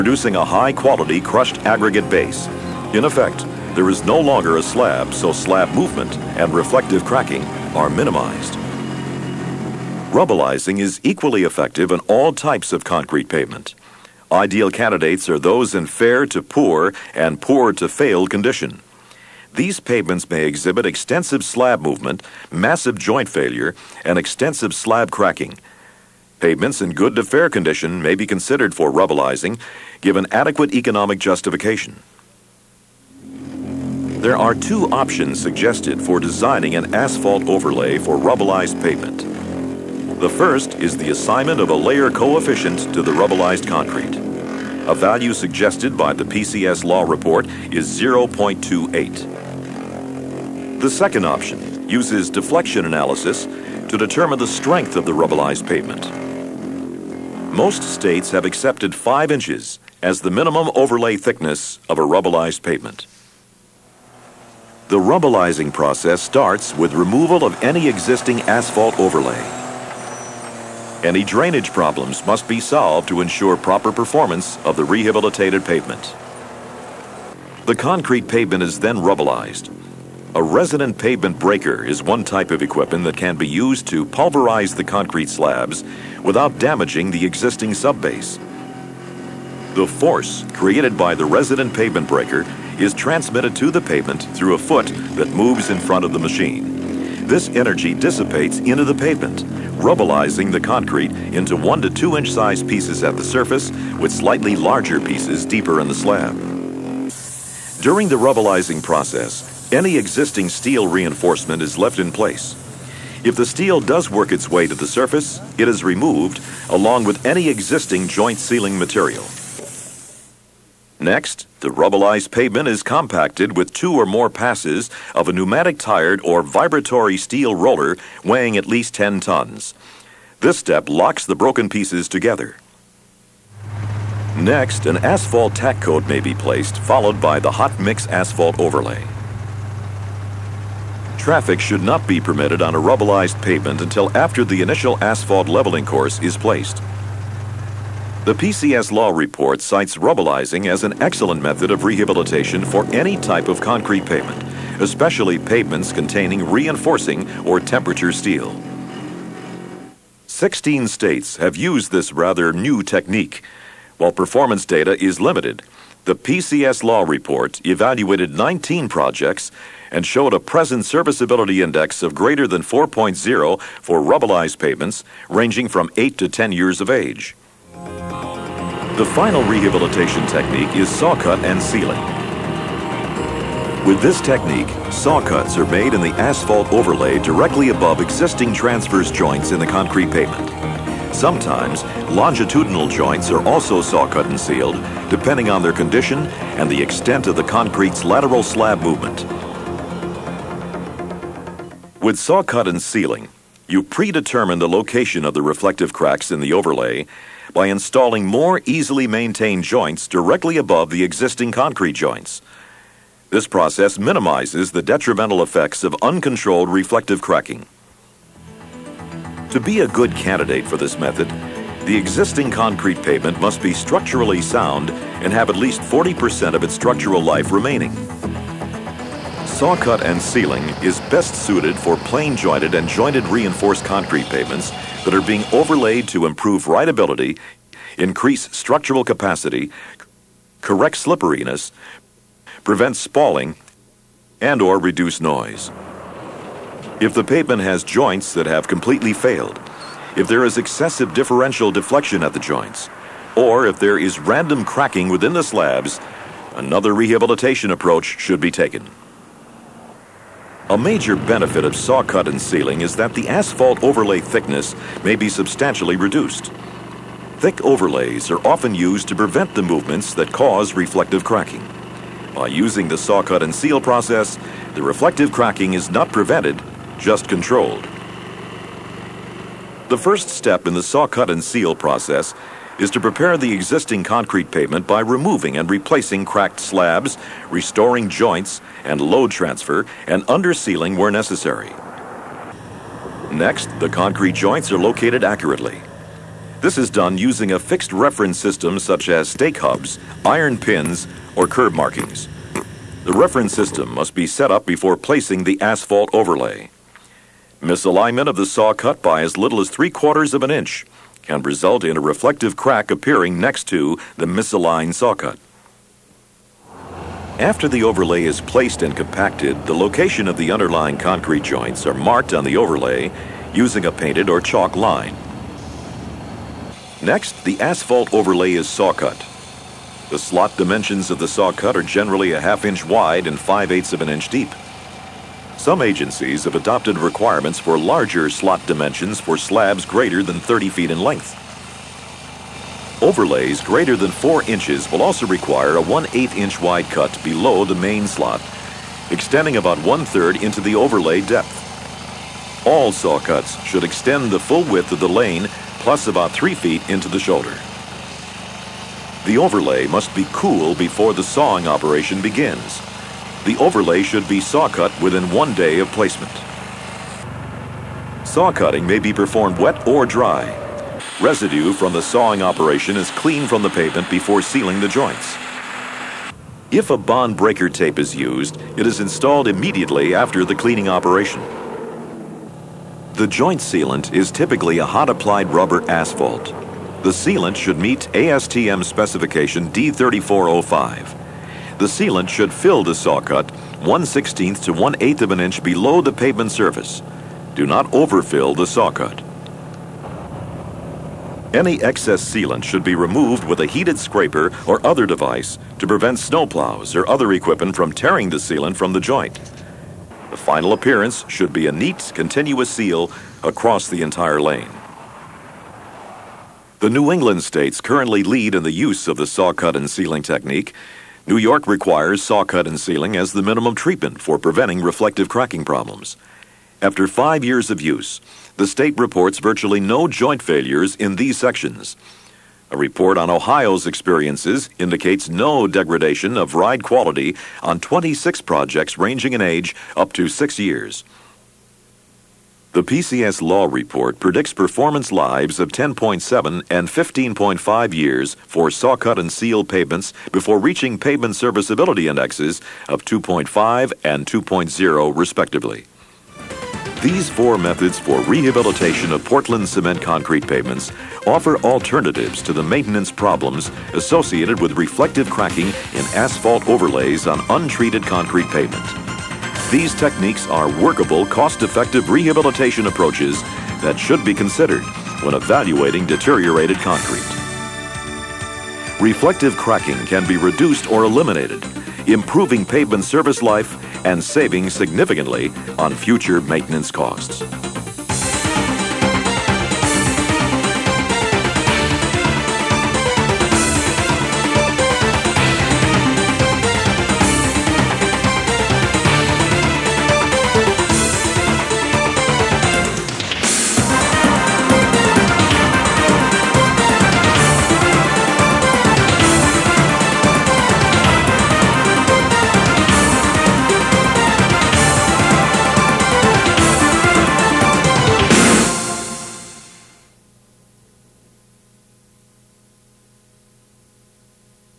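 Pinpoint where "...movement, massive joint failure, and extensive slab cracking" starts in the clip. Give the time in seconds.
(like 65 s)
21 s.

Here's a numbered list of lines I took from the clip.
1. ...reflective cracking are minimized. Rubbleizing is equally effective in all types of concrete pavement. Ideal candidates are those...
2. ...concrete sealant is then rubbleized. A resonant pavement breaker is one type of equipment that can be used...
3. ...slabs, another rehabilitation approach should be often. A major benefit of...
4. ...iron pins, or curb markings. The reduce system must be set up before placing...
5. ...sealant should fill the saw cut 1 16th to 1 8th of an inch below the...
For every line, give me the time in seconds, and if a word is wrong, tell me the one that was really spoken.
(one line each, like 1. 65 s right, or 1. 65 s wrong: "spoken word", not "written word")
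1. 6 s right
2. 77 s wrong: "pavement", not "sealant"
3. 255 s wrong: "taken", not "often"
4. 300 s wrong: "reference", not "reduce"
5. 391 s right.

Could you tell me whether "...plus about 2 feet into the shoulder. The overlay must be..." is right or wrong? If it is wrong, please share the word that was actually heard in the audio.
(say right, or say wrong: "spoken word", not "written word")
wrong: "3", not "2".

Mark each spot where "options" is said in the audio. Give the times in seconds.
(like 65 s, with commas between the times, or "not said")
34 s, 51 s.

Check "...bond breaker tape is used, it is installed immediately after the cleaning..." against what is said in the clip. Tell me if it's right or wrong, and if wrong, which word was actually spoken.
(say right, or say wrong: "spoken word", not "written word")
right.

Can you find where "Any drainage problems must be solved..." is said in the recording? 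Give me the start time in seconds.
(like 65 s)
71 s.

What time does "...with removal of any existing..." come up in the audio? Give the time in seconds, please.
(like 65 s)
66 s.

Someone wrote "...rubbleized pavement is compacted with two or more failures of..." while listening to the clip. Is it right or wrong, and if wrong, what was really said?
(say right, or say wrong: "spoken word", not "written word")
wrong: "passes", not "failures".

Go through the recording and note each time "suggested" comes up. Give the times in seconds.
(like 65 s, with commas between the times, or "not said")
35 s, 45 s.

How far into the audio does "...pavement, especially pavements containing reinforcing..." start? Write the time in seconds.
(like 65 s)
154 s.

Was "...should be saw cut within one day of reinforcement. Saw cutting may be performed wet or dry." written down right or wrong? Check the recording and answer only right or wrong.
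wrong.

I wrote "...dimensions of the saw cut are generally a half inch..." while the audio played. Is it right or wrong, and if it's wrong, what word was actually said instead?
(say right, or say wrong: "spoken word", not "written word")
right.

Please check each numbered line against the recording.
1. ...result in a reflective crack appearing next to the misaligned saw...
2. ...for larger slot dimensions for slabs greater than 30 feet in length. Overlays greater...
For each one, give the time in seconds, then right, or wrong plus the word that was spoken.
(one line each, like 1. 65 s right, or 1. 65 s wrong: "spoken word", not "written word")
1. 311 s right
2. 337 s right.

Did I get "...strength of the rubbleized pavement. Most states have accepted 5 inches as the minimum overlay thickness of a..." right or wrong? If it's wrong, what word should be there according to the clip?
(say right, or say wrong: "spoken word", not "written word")
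right.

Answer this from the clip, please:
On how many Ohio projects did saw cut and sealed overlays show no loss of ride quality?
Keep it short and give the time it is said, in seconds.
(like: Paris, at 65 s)
26, at 437 s.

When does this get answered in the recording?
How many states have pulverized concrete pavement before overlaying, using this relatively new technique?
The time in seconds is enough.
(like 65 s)
160 s.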